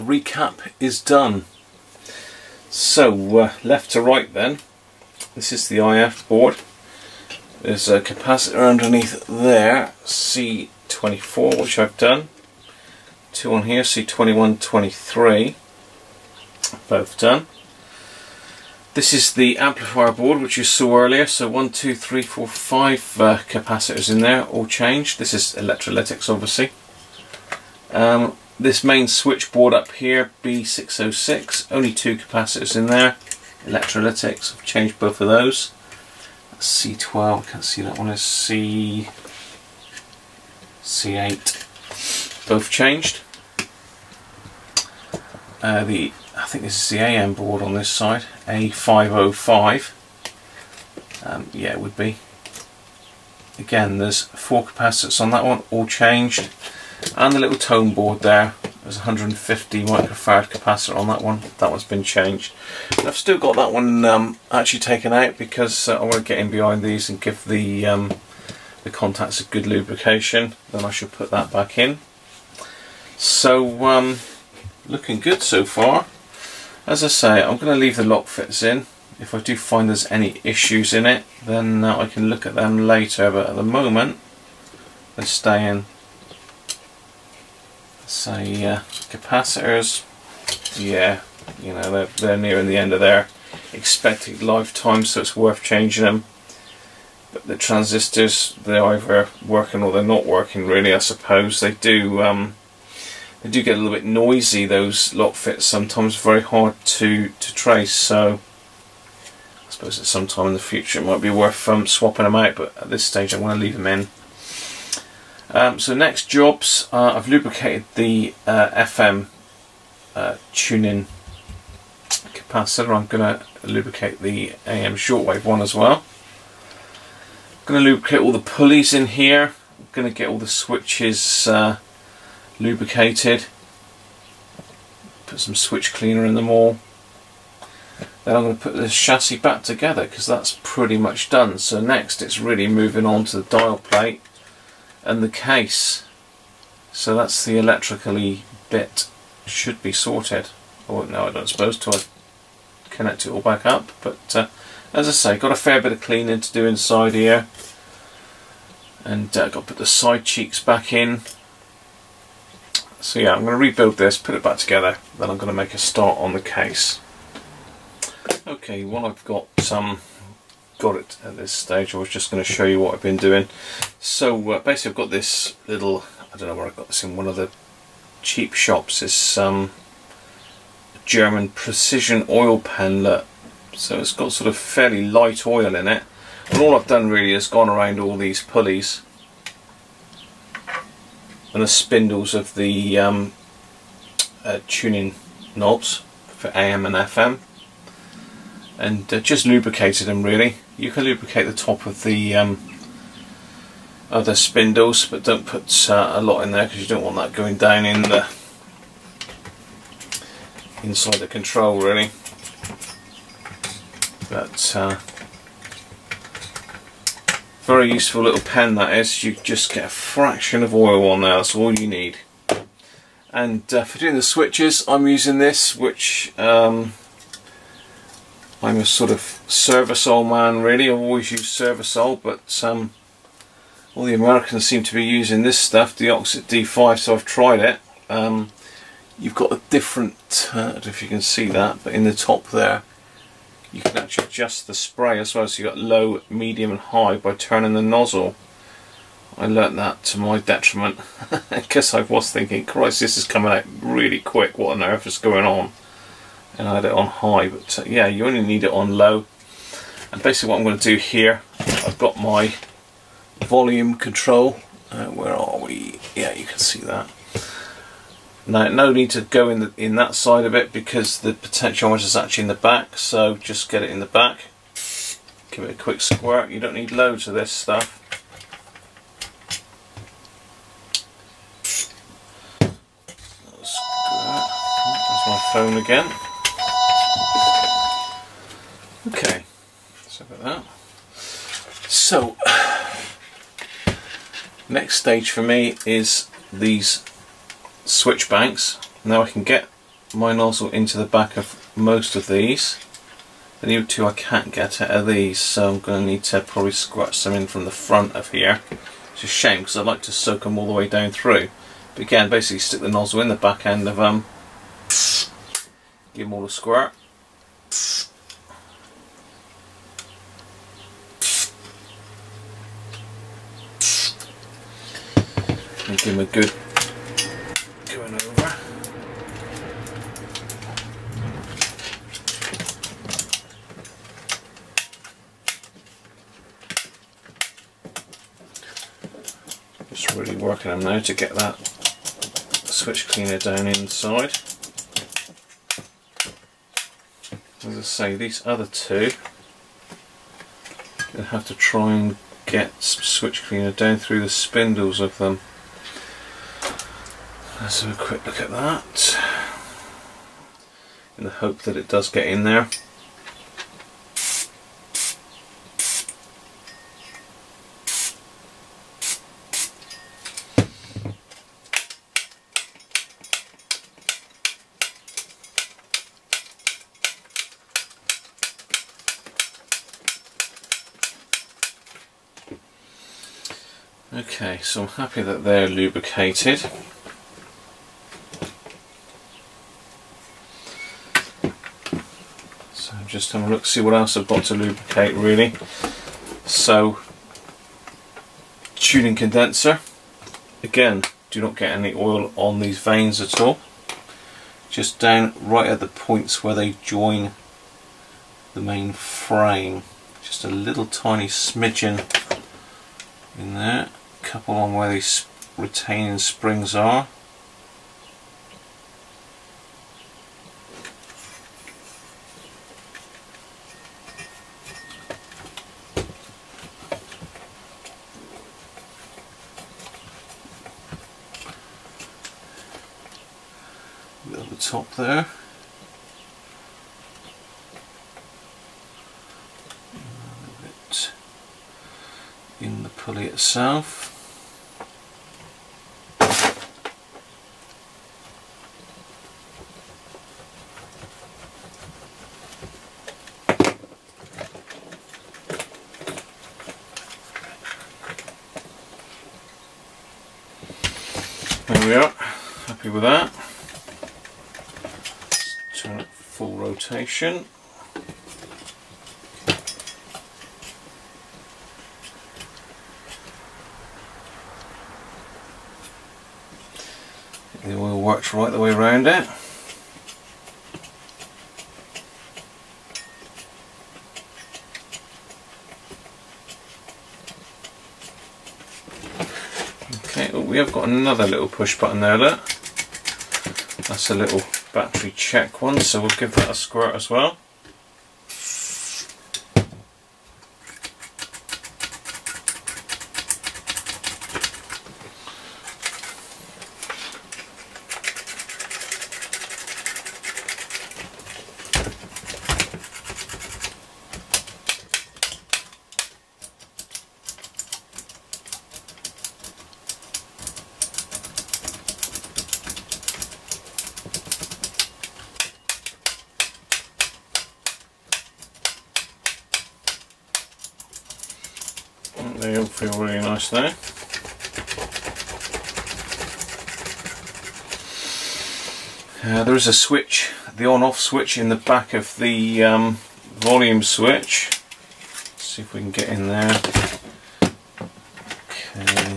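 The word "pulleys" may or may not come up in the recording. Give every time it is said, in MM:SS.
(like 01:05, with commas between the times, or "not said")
02:08, 03:08, 07:22.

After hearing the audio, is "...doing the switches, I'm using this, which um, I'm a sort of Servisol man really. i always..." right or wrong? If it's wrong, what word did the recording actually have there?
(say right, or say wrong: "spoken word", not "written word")
right.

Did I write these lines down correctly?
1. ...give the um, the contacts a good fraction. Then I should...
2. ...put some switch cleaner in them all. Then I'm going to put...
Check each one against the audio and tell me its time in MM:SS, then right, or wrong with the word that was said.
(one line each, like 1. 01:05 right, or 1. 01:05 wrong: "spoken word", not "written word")
1. 01:07 wrong: "lubrication", not "fraction"
2. 02:15 right.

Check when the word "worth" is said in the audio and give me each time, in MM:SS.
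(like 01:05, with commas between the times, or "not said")
01:35, 01:51.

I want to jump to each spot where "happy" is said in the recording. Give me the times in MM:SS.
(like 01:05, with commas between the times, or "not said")
06:24, 07:42.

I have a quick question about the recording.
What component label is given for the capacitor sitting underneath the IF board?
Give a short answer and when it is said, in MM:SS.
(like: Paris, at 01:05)
C24, at 00:10.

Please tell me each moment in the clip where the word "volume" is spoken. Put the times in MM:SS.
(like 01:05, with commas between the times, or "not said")
04:23, 09:03.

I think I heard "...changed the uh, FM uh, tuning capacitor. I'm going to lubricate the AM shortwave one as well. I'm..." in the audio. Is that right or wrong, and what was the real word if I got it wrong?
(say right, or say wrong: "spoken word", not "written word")
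wrong: "lubricated", not "changed".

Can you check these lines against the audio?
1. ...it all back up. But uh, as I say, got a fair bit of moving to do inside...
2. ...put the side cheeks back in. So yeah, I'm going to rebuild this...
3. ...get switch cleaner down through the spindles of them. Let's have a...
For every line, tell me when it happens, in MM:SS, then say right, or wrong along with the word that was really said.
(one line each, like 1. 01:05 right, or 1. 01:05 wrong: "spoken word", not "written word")
1. 02:33 wrong: "cleaning", not "moving"
2. 02:39 right
3. 05:52 right.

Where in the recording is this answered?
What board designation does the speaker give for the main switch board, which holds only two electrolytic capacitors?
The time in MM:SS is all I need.
00:30.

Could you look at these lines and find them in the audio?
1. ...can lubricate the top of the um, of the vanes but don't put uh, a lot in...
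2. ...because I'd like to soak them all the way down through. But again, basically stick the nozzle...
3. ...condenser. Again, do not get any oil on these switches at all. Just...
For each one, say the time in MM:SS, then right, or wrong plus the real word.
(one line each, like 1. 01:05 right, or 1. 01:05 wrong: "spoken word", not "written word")
1. 03:20 wrong: "spindles", not "vanes"
2. 05:09 right
3. 06:39 wrong: "vanes", not "switches".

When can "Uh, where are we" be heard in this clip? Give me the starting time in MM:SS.
04:24.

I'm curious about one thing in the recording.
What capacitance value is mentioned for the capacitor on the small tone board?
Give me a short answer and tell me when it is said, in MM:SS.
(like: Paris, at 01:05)
150 microfarad, at 00:58.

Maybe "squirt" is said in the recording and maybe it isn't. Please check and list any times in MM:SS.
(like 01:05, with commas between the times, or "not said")
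04:36, 05:16, 08:16.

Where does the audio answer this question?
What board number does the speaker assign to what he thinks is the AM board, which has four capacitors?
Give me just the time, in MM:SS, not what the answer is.
00:48.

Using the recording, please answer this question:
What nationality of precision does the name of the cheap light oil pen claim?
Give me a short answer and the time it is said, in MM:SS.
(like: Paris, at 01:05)
German, at 03:01.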